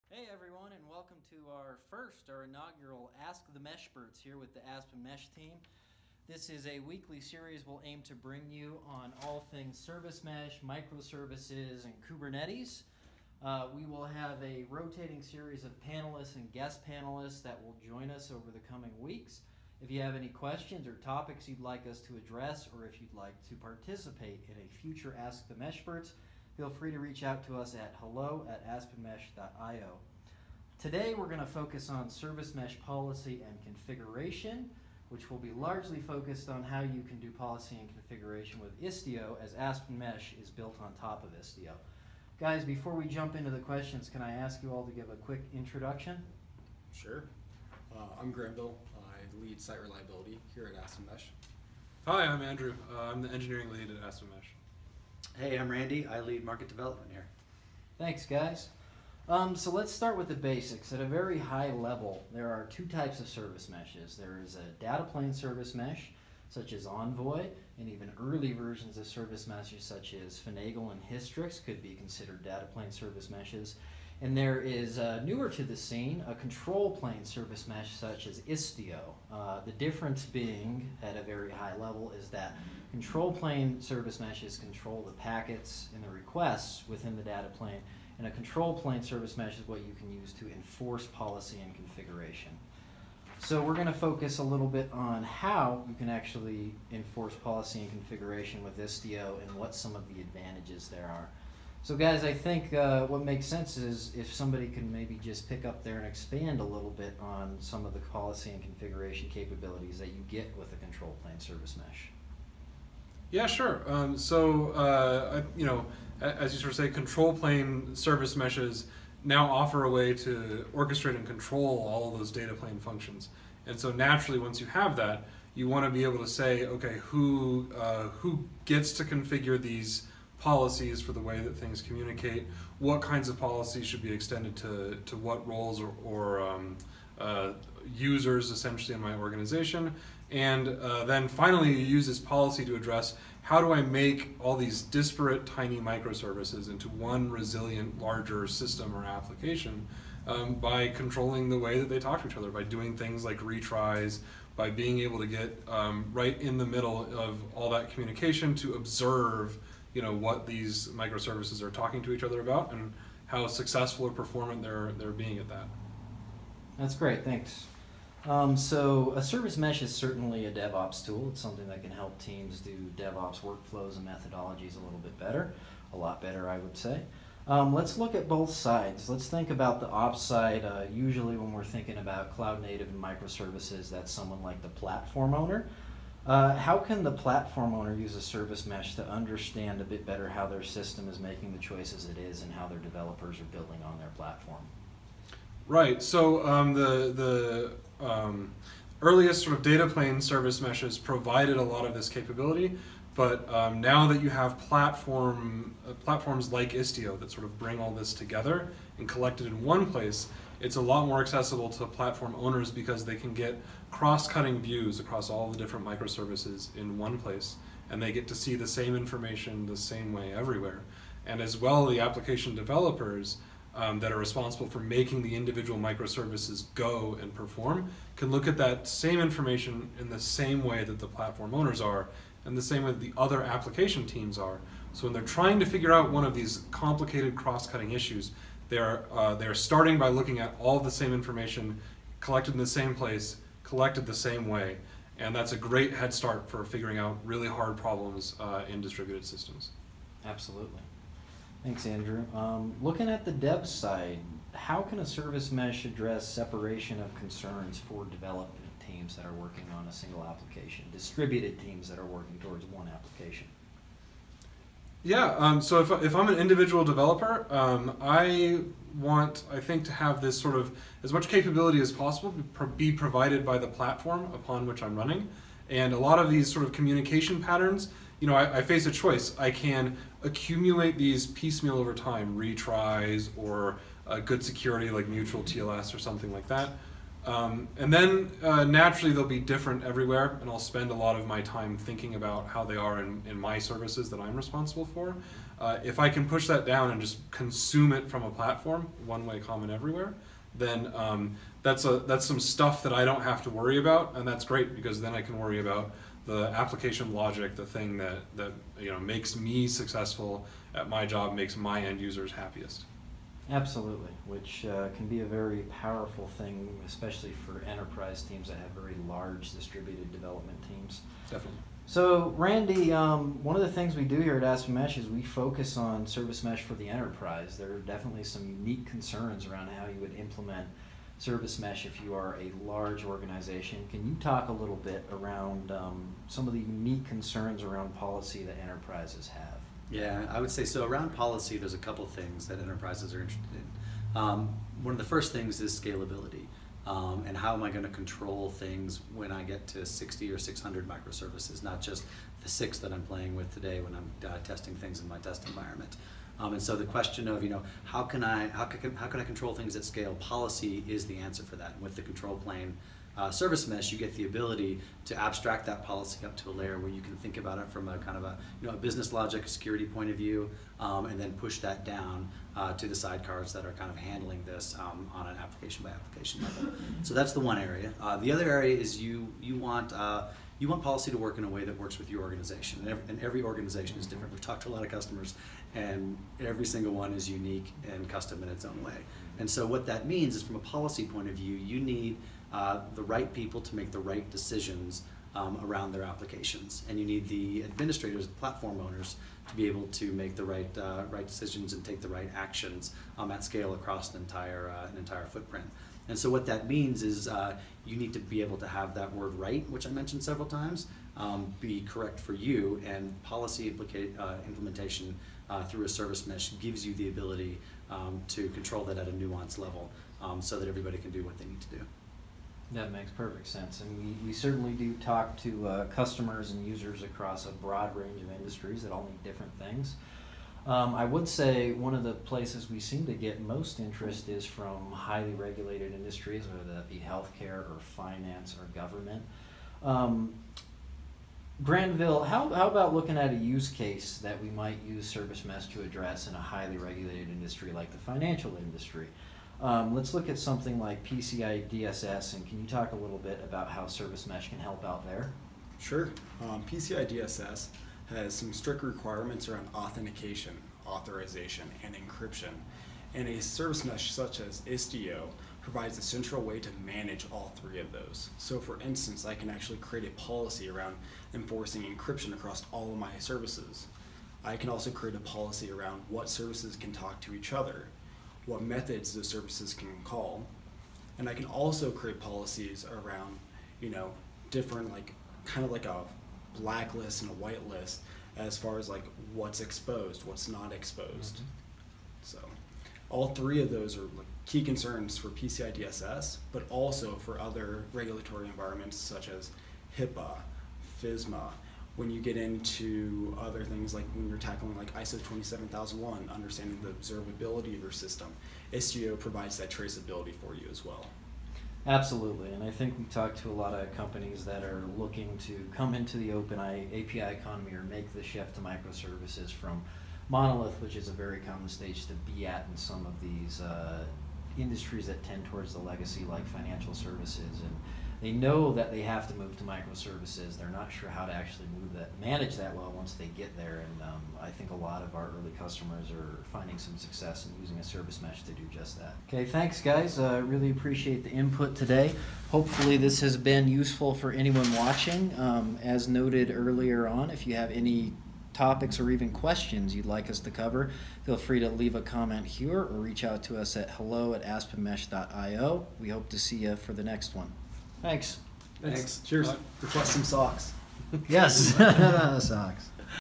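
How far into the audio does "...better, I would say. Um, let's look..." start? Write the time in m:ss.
2:56.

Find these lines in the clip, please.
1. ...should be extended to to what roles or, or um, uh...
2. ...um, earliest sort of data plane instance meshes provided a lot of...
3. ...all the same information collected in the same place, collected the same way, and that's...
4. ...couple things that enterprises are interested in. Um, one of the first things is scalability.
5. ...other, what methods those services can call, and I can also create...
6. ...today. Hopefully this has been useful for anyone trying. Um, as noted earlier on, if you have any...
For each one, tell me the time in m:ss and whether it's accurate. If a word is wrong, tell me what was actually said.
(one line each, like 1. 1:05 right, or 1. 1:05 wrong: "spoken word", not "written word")
1. 2:13 right
2. 3:18 wrong: "service", not "instance"
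3. 4:00 right
4. 5:41 right
5. 7:57 right
6. 9:01 wrong: "watching", not "trying".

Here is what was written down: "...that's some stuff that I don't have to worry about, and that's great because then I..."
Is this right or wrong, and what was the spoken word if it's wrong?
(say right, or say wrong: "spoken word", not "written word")
right.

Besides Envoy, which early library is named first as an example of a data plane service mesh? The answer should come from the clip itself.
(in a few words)
Finagle.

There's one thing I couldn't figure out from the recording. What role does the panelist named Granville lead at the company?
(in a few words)
Site reliability.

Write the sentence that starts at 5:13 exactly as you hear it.
Absolutely, which uh, can be a very powerful thing, especially for enterprise teams that have very large distributed development teams.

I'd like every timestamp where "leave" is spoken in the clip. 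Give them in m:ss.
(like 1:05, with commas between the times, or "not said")
9:11.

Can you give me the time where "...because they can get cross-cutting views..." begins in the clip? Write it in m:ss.
3:32.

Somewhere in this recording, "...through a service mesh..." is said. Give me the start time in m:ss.
6:55.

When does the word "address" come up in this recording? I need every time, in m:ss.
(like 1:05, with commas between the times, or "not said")
0:22, 2:22, 4:15, 7:25.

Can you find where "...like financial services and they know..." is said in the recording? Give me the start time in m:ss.
8:46.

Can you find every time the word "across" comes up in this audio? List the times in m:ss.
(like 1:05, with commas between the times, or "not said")
3:34, 6:43, 7:07, 7:52.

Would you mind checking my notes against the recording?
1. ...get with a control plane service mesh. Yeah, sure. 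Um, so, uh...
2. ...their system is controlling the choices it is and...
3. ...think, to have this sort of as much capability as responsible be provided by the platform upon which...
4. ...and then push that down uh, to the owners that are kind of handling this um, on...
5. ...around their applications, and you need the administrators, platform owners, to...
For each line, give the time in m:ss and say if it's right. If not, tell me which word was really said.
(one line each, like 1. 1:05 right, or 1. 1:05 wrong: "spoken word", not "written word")
1. 1:50 right
2. 3:10 wrong: "making", not "controlling"
3. 4:29 wrong: "possible", not "responsible"
4. 6:11 wrong: "sidecars", not "owners"
5. 6:35 right.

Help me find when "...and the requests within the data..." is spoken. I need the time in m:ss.
1:25.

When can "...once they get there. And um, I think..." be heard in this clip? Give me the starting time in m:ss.
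8:52.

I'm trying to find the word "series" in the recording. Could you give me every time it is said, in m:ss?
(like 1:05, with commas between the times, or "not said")
0:07, 0:15.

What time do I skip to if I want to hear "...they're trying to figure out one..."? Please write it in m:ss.
3:55.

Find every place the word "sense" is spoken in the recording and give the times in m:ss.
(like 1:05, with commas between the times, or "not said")
1:43, 7:03.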